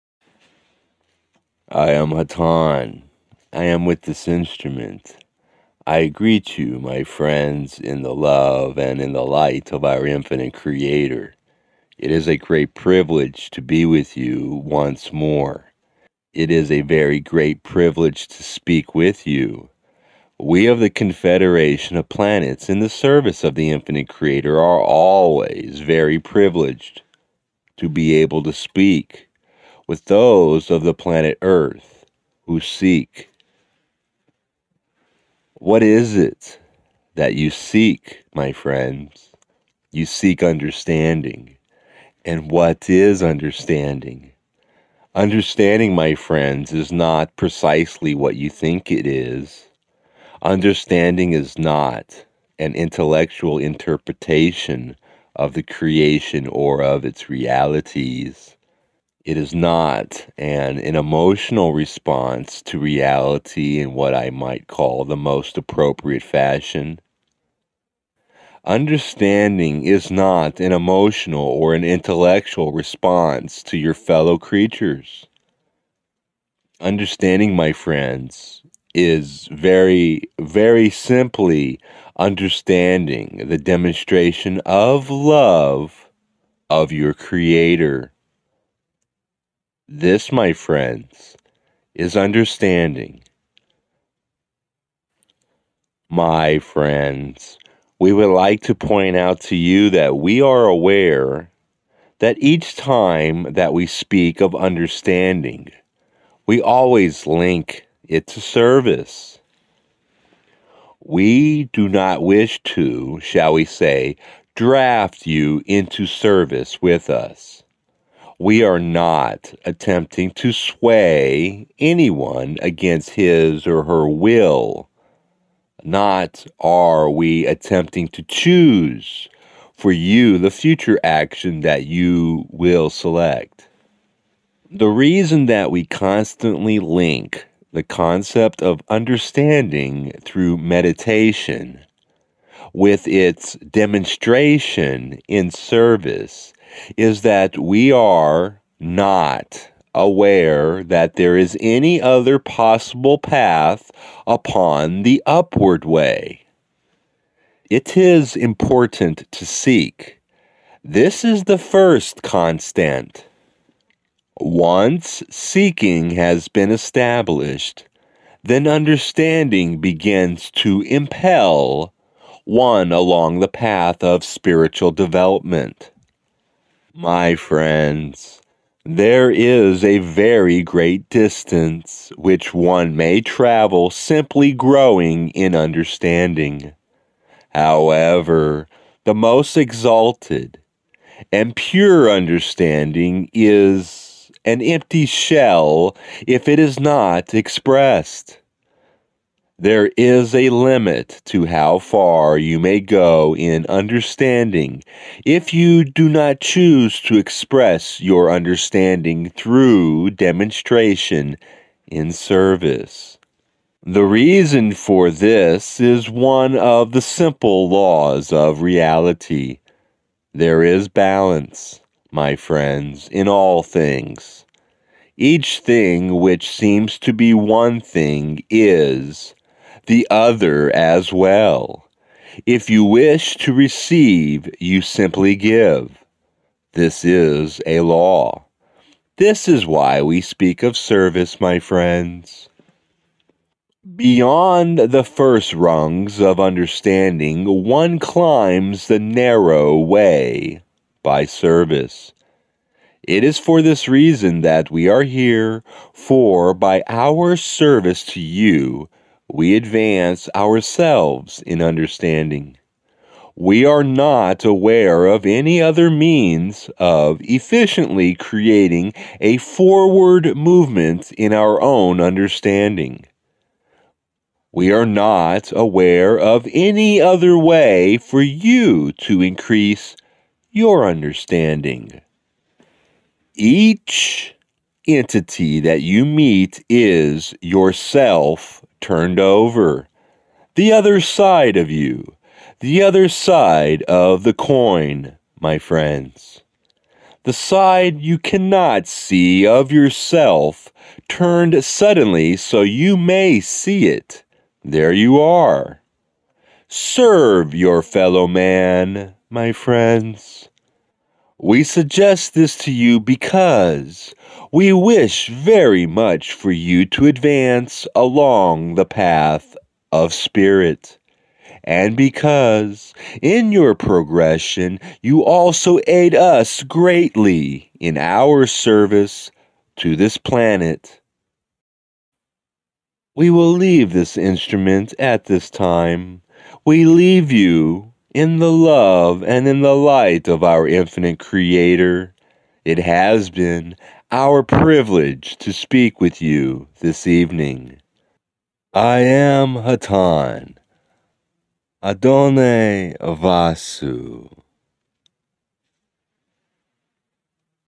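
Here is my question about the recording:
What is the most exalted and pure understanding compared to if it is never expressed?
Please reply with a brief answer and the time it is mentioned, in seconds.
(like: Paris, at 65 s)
an empty shell, at 194 s.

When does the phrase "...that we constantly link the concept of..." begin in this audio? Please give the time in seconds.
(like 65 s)
135 s.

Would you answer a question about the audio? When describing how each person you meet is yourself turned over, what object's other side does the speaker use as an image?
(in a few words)
the coin.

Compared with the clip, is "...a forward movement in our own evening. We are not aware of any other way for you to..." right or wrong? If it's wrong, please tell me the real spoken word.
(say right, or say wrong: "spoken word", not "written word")
wrong: "understanding", not "evening".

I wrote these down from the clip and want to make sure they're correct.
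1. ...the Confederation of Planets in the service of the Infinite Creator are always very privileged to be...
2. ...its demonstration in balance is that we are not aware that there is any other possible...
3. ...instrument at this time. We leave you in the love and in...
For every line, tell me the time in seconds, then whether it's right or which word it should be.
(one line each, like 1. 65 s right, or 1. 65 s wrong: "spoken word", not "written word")
1. 20 s right
2. 143 s wrong: "service", not "balance"
3. 334 s right.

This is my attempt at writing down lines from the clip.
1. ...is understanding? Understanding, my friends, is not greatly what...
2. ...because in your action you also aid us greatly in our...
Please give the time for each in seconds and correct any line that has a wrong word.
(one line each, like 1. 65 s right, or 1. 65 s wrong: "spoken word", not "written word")
1. 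42 s wrong: "precisely", not "greatly"
2. 321 s wrong: "progression", not "action".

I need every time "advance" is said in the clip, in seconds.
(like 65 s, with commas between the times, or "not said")
259 s, 317 s.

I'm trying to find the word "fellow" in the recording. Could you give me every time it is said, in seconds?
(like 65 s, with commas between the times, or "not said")
73 s, 307 s.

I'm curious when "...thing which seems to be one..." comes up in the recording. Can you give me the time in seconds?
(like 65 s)
225 s.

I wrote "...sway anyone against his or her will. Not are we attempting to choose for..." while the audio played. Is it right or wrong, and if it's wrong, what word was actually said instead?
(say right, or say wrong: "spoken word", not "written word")
right.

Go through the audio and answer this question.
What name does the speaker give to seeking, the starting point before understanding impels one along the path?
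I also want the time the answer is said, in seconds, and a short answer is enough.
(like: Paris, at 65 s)
the first constant, at 161 s.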